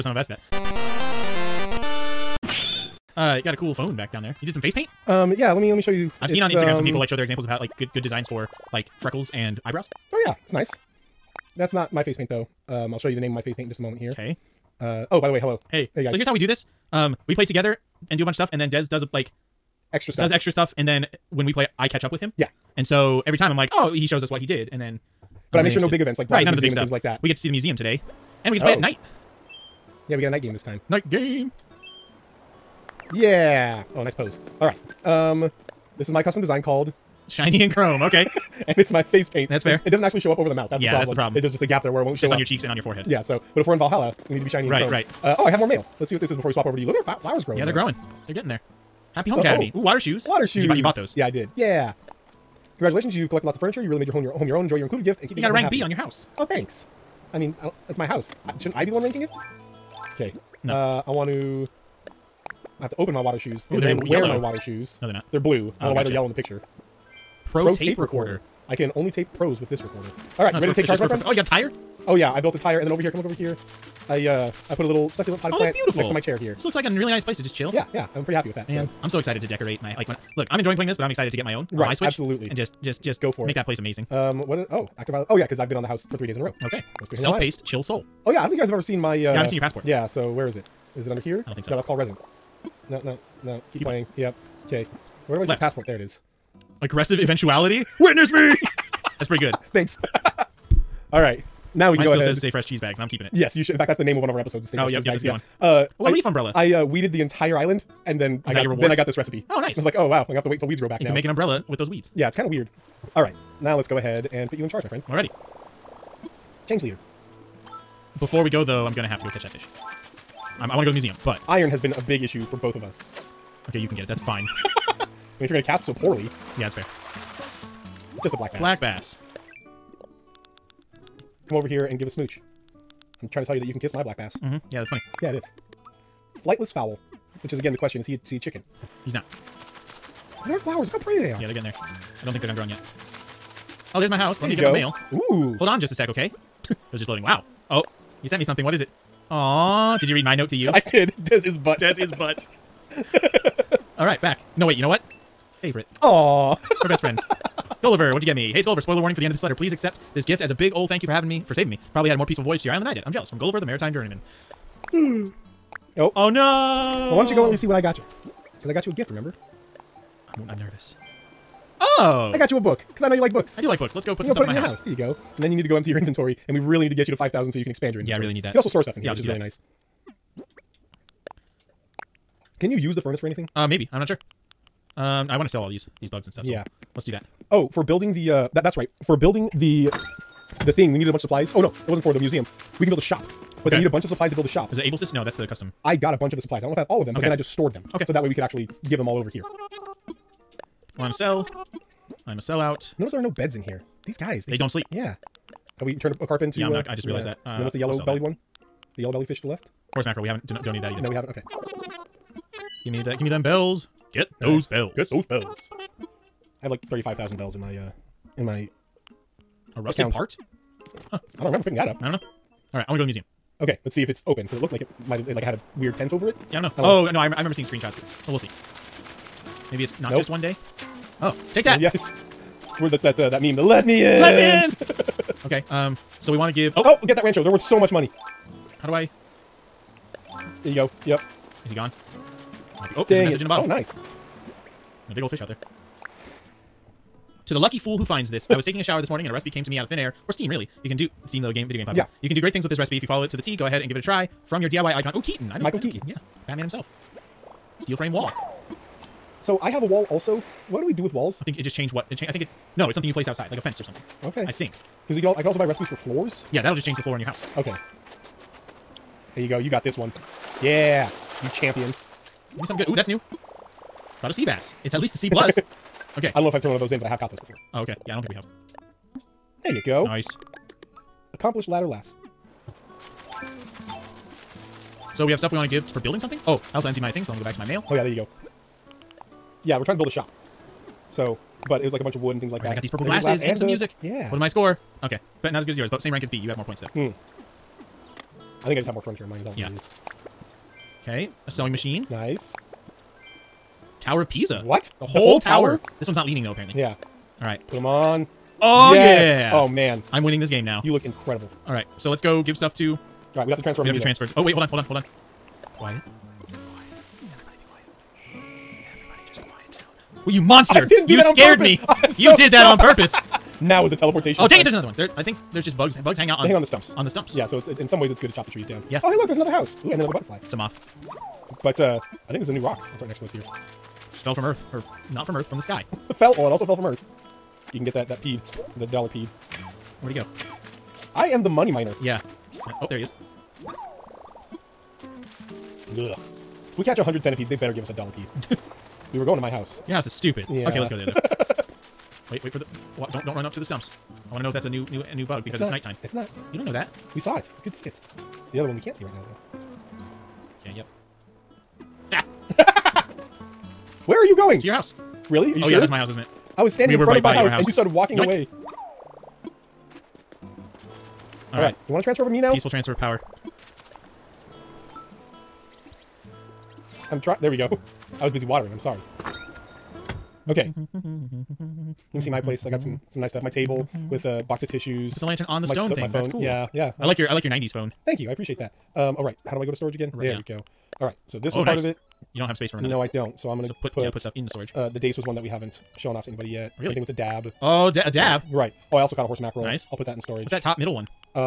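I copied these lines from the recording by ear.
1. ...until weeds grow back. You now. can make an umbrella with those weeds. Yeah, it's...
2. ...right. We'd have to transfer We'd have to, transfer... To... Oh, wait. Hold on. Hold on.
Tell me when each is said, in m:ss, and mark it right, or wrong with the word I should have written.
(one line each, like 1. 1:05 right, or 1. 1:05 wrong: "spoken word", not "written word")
1. 1:50 right
2. 5:13 right.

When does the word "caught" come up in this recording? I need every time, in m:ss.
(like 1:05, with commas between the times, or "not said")
4:37, 6:39.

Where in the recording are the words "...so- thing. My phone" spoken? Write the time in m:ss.
6:25.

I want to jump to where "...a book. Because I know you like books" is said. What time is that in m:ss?
2:52.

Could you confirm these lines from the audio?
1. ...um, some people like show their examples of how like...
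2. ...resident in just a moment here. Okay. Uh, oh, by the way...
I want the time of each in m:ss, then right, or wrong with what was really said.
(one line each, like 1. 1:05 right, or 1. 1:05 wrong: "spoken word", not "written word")
1. 0:06 right
2. 0:13 wrong: "paint", not "resident".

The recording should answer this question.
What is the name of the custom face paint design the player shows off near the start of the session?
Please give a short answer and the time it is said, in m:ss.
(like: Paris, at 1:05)
Shiny and chrome, at 0:37.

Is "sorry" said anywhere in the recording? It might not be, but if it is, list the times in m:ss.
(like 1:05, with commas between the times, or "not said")
5:22, 6:18.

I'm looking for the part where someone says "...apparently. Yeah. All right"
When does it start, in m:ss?
5:06.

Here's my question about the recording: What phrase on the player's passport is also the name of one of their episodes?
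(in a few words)
Stay Fresh Cheese Bags.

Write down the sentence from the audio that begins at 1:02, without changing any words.
I have to open my water shoes.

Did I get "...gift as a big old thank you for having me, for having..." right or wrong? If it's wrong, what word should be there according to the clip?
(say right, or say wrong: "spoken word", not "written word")
wrong: "saving", not "having".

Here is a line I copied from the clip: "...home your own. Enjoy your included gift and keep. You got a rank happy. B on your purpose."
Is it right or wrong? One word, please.
wrong.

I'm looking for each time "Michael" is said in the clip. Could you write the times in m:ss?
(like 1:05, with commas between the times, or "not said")
4:15.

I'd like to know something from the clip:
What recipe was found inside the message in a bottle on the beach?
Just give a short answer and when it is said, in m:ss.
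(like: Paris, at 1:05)
steel frame wall, at 4:17.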